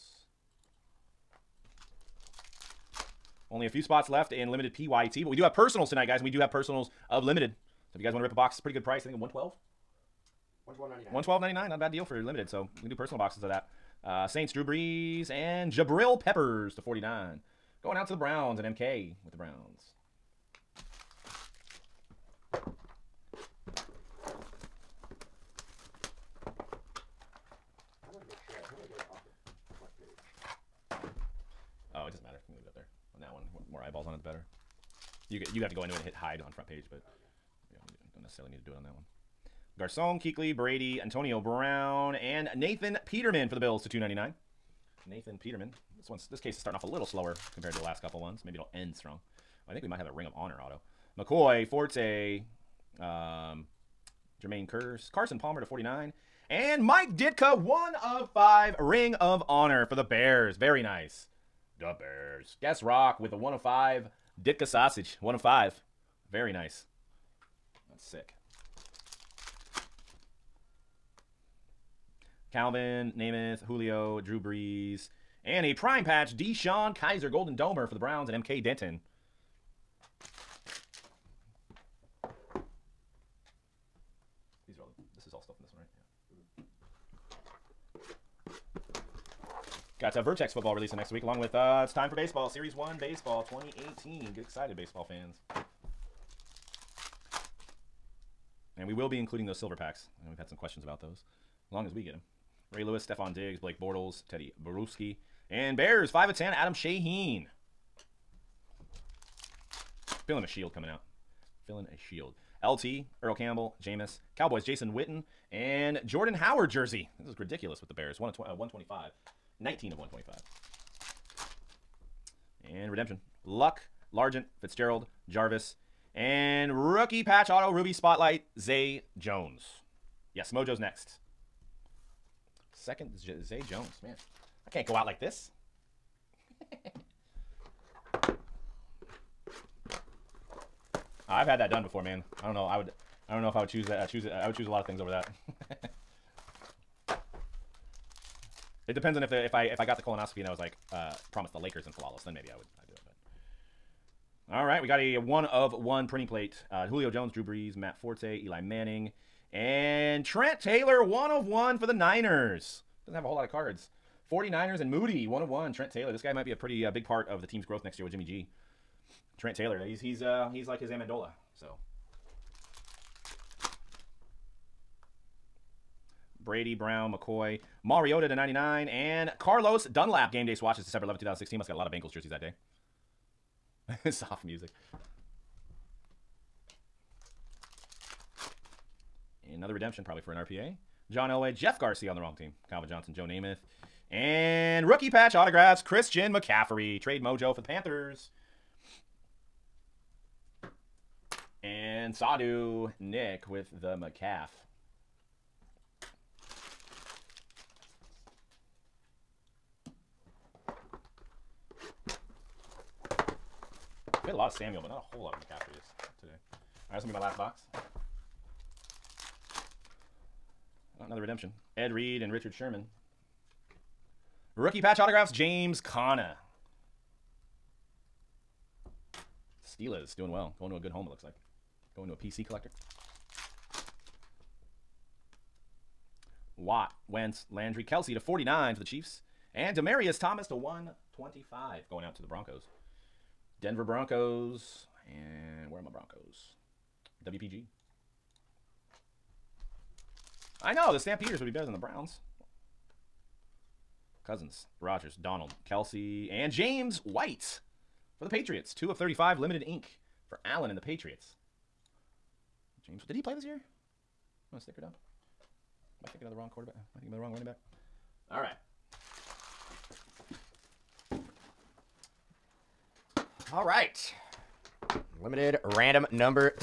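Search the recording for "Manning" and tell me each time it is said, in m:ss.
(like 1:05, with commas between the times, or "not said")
2:38.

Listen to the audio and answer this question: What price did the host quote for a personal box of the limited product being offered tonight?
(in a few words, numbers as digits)
$112.99.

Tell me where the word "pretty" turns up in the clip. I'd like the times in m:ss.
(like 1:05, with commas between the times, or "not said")
0:08, 2:46.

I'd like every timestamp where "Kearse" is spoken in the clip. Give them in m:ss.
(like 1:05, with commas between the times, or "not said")
0:54.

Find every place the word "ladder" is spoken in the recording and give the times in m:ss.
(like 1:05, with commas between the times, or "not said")
not said.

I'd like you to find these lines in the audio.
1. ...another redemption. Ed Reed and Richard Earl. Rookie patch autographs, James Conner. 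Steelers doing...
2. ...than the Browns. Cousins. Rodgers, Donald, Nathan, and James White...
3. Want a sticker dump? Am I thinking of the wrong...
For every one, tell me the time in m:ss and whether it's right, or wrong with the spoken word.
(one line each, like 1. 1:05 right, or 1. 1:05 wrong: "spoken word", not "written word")
1. 3:41 wrong: "Sherman", not "Earl"
2. 4:11 wrong: "Kelce", not "Nathan"
3. 4:24 right.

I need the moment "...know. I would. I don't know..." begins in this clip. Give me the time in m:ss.
2:22.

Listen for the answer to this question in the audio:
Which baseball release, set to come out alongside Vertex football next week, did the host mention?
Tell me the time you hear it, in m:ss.
1:32.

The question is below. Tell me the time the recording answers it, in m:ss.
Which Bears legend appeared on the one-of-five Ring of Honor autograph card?
0:56.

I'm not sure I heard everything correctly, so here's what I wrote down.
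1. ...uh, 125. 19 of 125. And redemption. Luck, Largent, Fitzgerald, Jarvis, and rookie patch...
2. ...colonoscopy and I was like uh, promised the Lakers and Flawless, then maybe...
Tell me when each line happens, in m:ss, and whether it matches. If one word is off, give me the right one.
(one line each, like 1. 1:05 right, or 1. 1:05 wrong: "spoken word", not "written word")
1. 1:58 right
2. 2:30 right.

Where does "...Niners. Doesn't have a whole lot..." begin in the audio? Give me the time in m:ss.
2:41.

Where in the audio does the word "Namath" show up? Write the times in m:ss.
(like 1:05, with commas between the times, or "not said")
1:13, 3:13.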